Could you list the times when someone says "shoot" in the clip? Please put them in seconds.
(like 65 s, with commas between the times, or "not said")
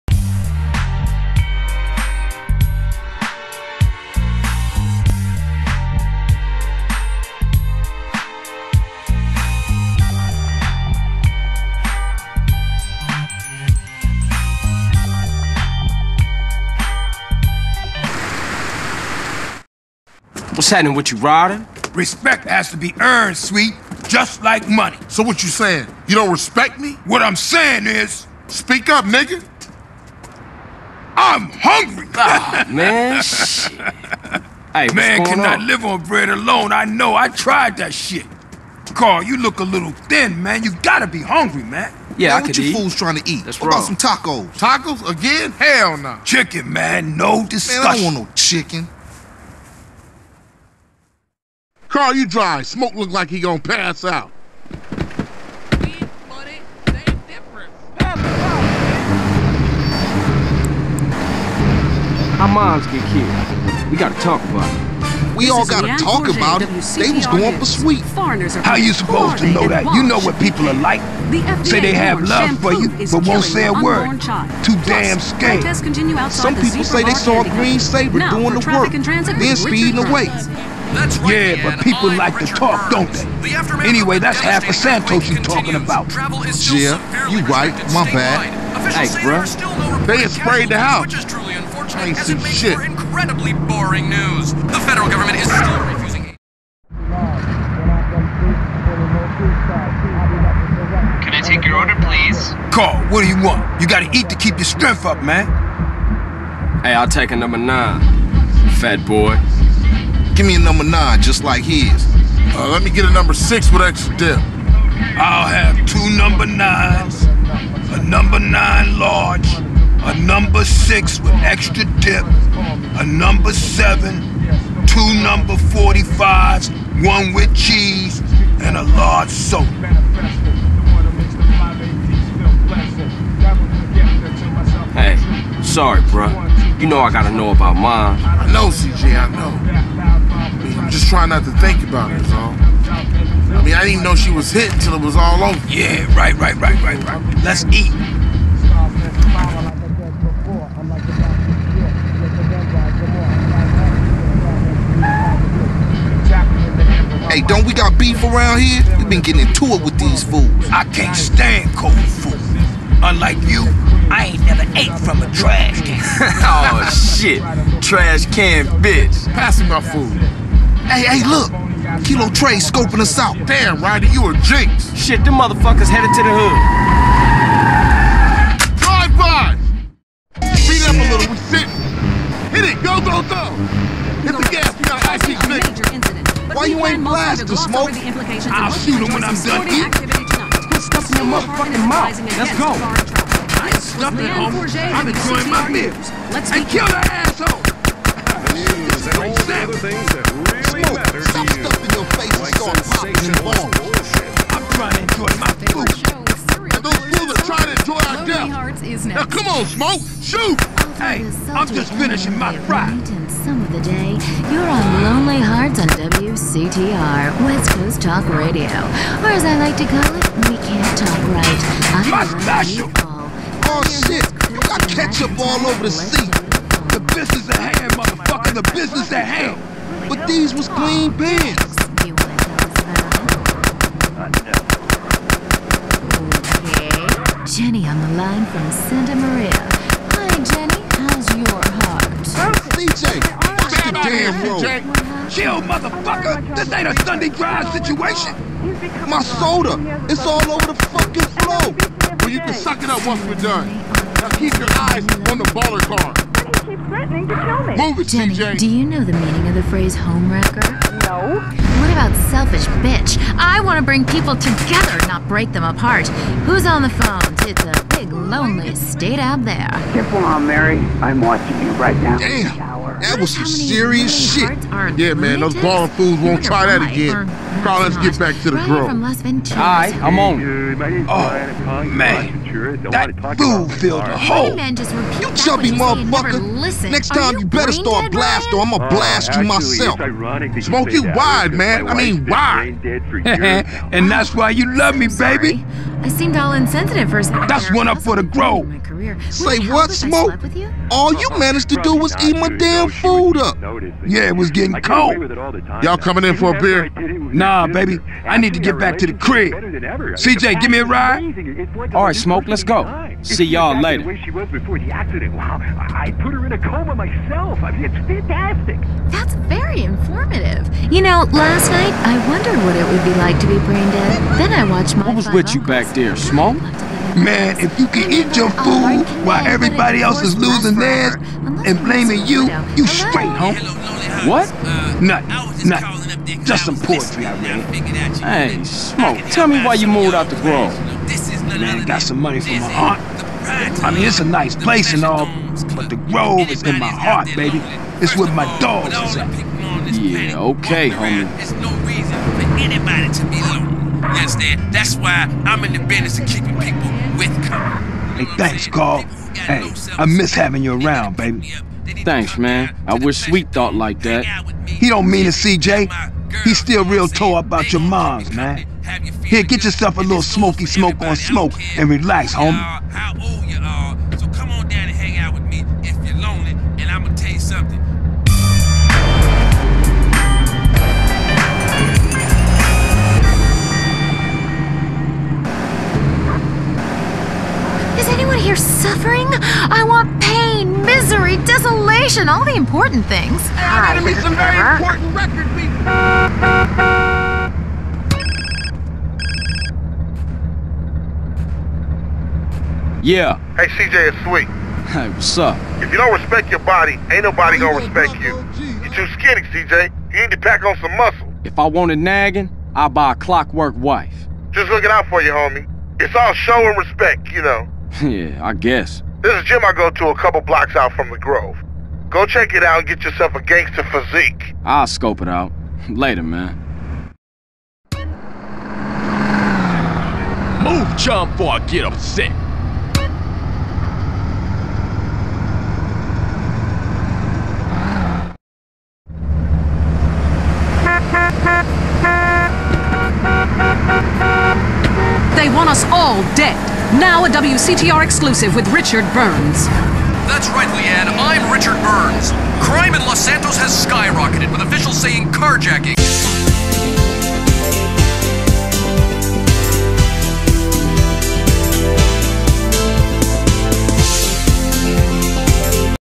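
188 s, 210 s.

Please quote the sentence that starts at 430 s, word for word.
Move, chump, or I get upset.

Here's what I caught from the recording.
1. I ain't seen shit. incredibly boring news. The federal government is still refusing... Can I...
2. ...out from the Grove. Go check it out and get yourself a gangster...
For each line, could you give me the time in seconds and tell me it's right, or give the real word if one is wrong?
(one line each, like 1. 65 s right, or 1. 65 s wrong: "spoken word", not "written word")
1. 91 s right
2. 420 s right.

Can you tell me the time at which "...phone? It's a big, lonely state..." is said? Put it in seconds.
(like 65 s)
266 s.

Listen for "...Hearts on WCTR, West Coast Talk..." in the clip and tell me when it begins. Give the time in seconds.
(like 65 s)
215 s.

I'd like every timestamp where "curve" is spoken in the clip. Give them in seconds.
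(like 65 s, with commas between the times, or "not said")
not said.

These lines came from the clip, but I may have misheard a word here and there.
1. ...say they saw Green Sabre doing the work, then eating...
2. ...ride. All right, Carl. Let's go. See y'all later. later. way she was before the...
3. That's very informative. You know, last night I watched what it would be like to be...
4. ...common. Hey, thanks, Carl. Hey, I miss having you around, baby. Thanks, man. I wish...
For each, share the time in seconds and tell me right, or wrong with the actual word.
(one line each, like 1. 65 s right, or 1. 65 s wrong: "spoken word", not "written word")
1. 76 s wrong: "speeding", not "eating"
2. 310 s wrong: "Smoke", not "Carl"
3. 319 s wrong: "wondered", not "watched"
4. 357 s right.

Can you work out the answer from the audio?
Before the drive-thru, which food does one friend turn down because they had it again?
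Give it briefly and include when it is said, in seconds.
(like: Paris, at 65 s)
Tacos, at 44 s.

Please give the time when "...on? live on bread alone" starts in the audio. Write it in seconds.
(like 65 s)
35 s.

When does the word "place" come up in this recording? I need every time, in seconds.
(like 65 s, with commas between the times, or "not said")
344 s.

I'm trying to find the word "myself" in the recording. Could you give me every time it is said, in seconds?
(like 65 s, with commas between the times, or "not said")
289 s, 316 s.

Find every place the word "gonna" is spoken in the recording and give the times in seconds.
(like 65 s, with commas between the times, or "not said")
53 s, 407 s.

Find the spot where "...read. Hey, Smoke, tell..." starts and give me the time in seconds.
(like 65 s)
337 s.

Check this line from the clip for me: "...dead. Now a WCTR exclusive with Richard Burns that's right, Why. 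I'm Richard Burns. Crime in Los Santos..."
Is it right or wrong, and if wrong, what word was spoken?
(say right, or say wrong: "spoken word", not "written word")
wrong: "Leanne", not "Why".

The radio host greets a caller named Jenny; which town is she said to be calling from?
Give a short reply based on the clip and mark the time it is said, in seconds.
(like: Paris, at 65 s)
Santa Maria, at 238 s.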